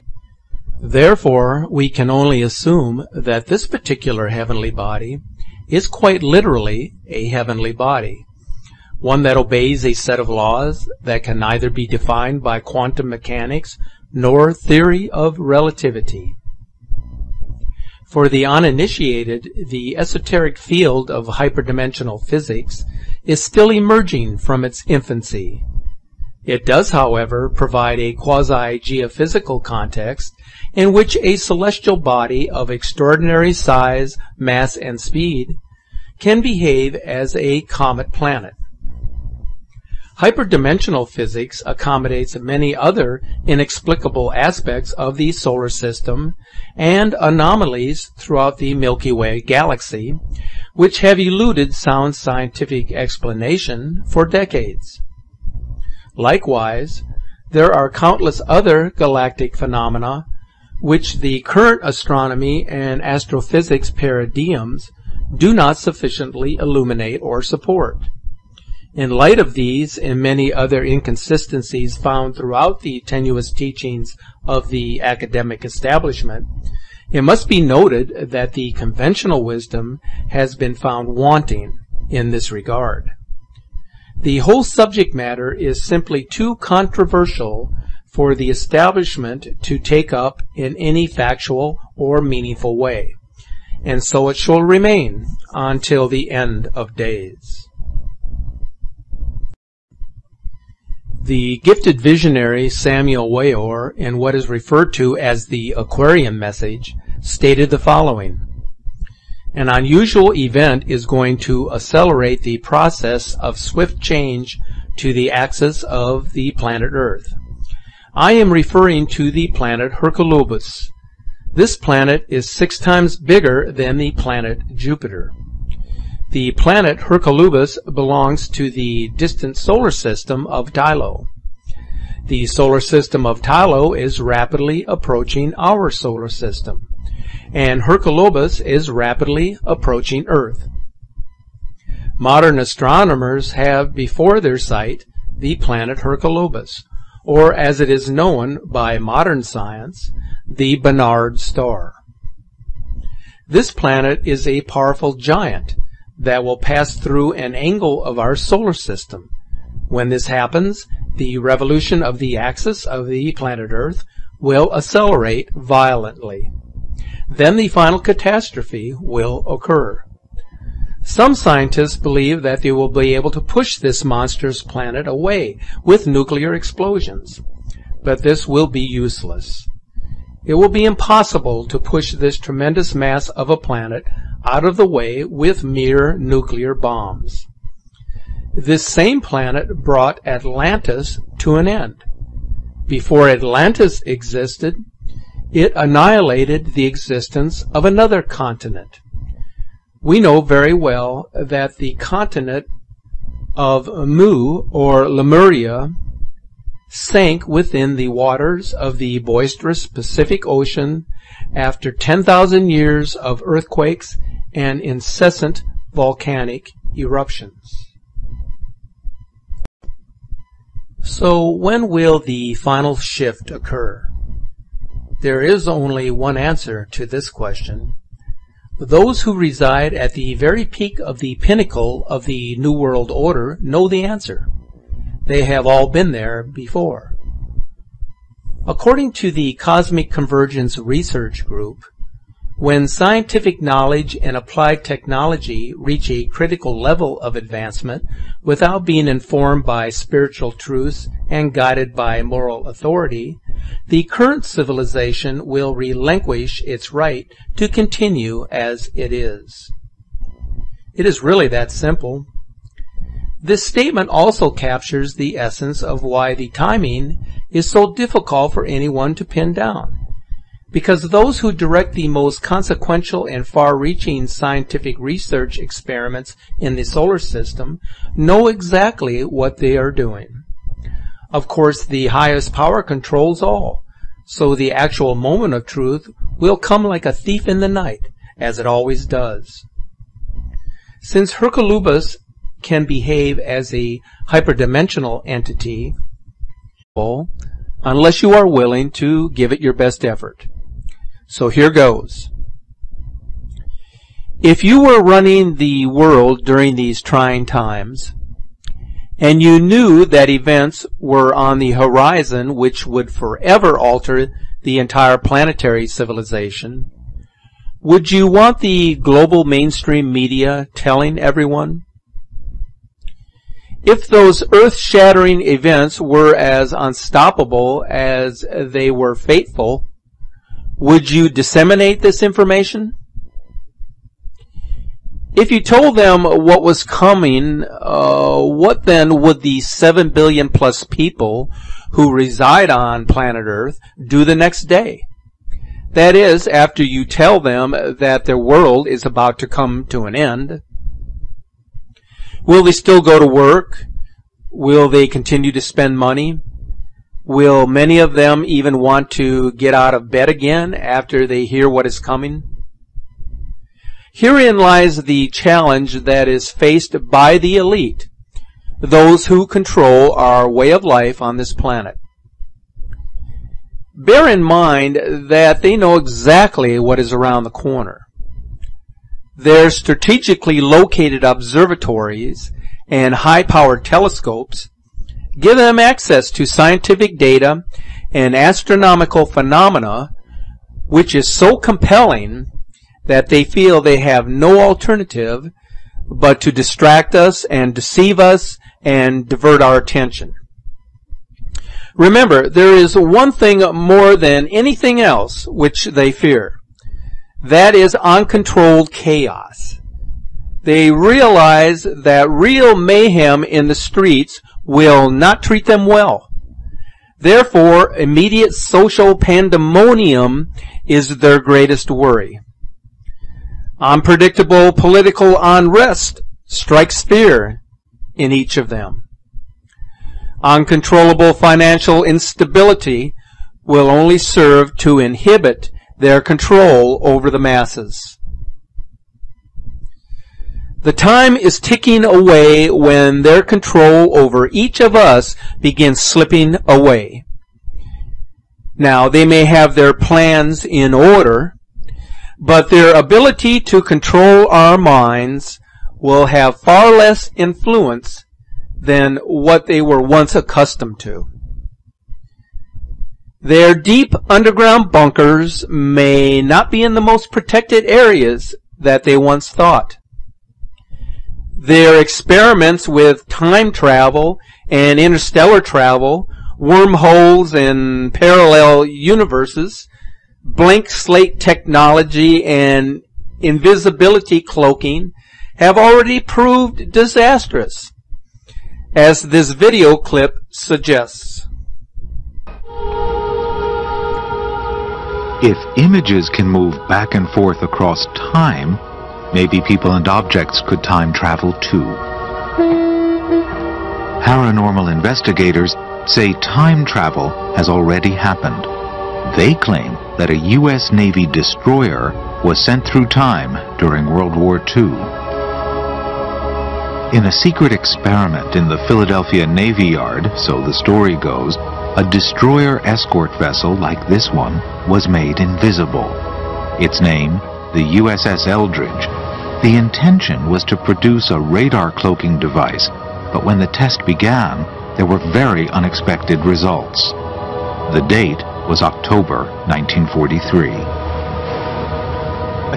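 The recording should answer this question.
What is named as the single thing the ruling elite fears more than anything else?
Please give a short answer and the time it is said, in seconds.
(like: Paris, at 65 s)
Uncontrolled chaos, at 407 s.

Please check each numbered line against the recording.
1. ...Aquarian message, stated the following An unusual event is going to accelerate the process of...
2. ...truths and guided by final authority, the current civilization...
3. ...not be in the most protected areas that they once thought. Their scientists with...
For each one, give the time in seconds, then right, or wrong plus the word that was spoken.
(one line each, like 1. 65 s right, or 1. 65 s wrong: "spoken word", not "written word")
1. 105 s right
2. 250 s wrong: "moral", not "final"
3. 466 s wrong: "experiments", not "scientists".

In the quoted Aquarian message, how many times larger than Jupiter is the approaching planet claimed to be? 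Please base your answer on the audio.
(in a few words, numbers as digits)
6.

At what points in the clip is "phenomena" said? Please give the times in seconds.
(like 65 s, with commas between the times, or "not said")
59 s, 389 s.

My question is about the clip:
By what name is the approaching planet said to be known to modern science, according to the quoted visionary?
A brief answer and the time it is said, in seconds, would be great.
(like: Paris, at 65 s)
Barnard star, at 150 s.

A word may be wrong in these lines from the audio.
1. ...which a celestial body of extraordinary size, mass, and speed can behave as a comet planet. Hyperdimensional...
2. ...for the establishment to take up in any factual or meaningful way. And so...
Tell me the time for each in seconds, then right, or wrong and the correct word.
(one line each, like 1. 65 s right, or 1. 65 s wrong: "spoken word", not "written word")
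1. 30 s right
2. 88 s right.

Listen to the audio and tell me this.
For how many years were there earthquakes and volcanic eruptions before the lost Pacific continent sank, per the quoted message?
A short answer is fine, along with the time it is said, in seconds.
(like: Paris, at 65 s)
10,000, at 211 s.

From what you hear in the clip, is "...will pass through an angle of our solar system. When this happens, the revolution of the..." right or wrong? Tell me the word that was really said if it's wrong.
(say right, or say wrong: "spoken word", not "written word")
right.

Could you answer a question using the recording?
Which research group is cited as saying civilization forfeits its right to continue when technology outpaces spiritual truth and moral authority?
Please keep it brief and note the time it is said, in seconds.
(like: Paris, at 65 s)
Cosmic Convergence Research Group, at 239 s.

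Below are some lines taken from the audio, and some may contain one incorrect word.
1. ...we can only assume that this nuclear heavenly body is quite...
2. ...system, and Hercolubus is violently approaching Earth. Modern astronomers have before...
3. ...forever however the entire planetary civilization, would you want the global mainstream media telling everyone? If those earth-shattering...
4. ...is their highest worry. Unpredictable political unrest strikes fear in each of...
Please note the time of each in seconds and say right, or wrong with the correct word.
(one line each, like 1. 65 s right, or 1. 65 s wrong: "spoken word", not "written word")
1. 1 s wrong: "particular", not "nuclear"
2. 136 s wrong: "rapidly", not "violently"
3. 313 s wrong: "alter", not "however"
4. 420 s wrong: "greatest", not "highest".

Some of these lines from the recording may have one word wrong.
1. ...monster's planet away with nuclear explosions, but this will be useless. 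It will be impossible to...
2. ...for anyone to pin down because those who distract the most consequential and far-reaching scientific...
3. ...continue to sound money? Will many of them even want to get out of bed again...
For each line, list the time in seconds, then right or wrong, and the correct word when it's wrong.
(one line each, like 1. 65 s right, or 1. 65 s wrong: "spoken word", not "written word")
1. 174 s right
2. 268 s wrong: "direct", not "distract"
3. 355 s wrong: "spend", not "sound".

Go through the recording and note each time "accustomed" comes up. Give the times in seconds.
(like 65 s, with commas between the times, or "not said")
460 s.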